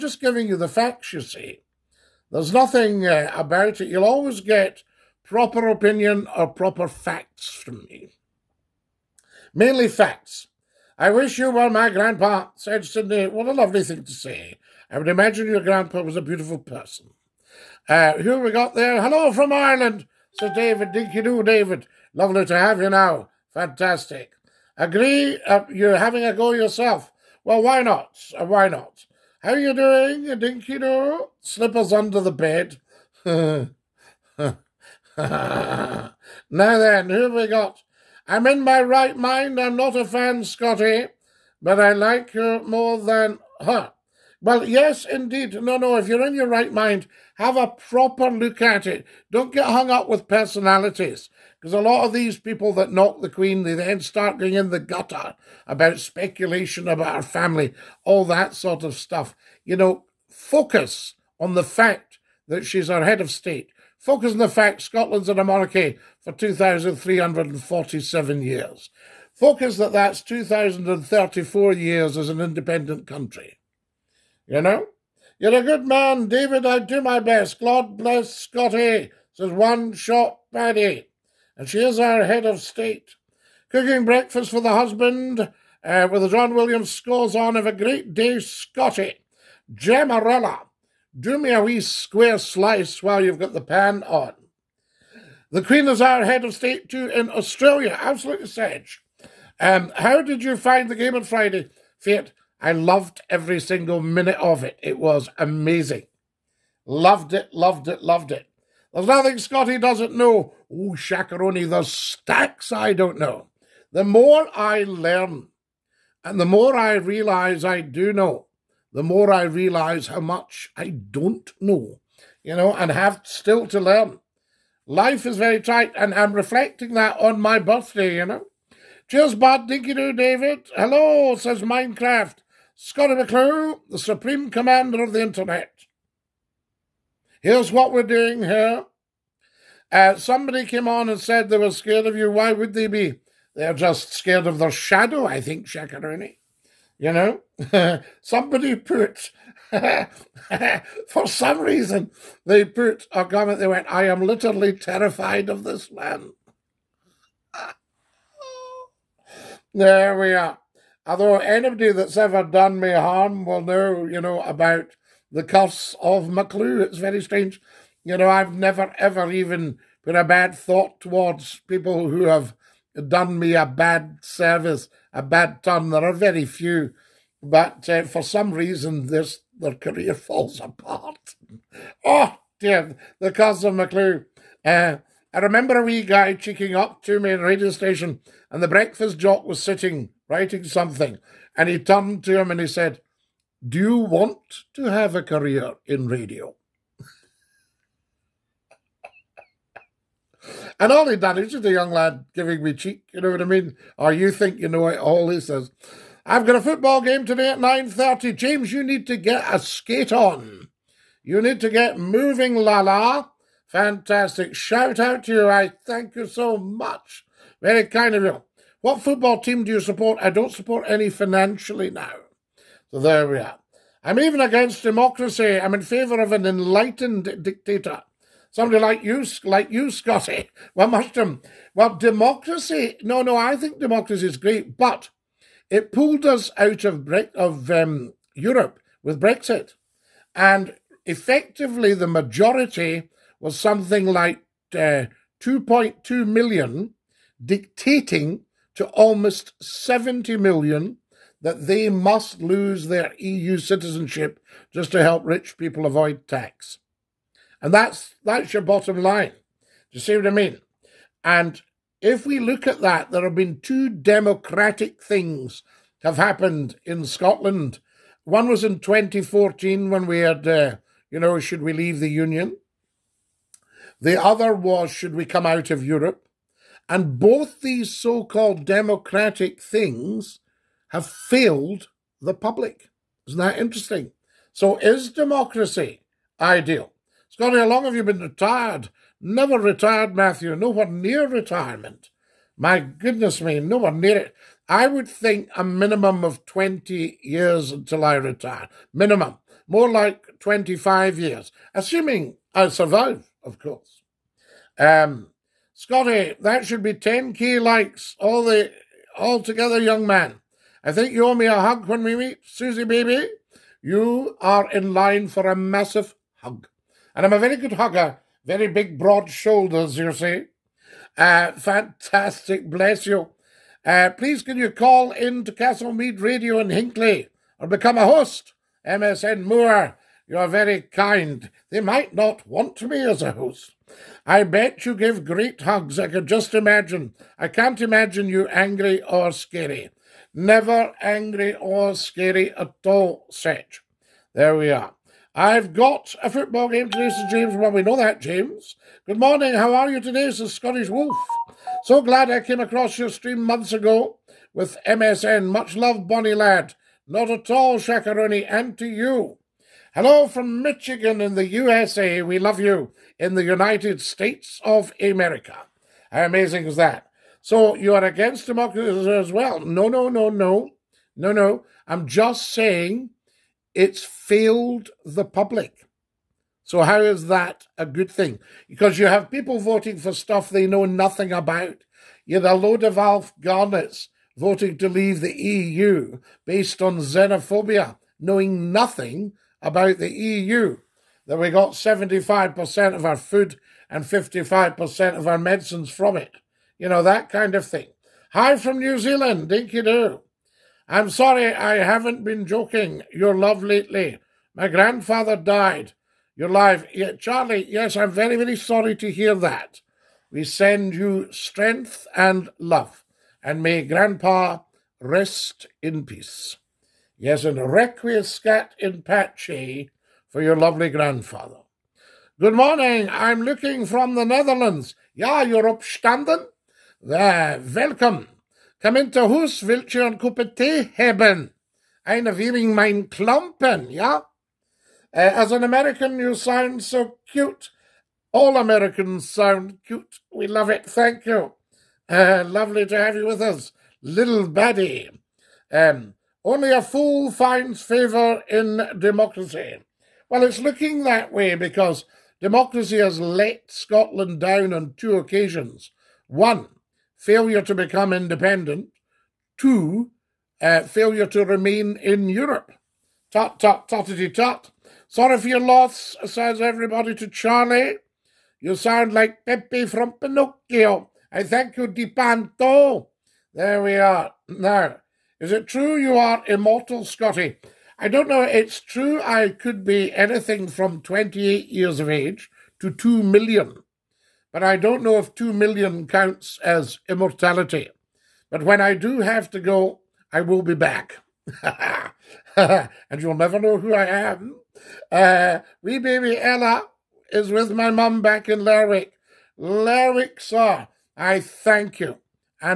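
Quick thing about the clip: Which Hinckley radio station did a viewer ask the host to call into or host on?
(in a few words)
Castle Mead Radio.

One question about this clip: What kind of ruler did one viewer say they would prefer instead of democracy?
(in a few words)
An enlightened dictator.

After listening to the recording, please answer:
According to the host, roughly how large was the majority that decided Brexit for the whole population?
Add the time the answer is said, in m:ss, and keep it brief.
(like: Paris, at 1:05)
2.2 million, at 4:05.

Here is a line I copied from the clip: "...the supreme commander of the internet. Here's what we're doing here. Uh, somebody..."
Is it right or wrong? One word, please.
right.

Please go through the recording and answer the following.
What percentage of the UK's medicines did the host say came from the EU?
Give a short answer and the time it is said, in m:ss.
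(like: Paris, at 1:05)
55%, at 6:34.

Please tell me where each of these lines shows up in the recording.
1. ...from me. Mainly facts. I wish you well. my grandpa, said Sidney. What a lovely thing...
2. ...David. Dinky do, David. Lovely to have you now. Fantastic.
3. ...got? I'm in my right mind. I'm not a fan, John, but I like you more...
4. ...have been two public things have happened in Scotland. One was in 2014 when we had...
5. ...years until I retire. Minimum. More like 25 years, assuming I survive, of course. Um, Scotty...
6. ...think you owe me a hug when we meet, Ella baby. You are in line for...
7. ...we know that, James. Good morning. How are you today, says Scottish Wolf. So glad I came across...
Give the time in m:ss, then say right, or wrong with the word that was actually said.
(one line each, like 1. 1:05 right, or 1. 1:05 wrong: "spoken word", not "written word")
1. 0:07 right
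2. 0:20 right
3. 0:37 wrong: "Scotty", not "John"
4. 4:23 wrong: "democratic", not "public"
5. 4:57 right
6. 5:10 wrong: "Susie", not "Ella"
7. 5:47 right.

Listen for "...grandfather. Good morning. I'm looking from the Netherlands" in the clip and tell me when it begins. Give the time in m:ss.
7:00.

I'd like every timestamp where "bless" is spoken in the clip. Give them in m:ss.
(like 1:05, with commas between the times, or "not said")
1:17, 5:22.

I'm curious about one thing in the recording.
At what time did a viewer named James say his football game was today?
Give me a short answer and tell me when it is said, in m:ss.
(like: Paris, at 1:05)
9.30, at 3:27.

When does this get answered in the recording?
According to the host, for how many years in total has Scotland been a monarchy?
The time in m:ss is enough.
1:06.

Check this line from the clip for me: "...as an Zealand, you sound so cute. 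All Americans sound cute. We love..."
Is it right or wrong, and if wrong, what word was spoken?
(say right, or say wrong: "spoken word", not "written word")
wrong: "American", not "Zealand".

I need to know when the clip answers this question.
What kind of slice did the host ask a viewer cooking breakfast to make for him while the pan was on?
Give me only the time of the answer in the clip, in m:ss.
1:31.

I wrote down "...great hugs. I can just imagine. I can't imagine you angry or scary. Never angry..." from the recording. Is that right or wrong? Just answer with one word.
right.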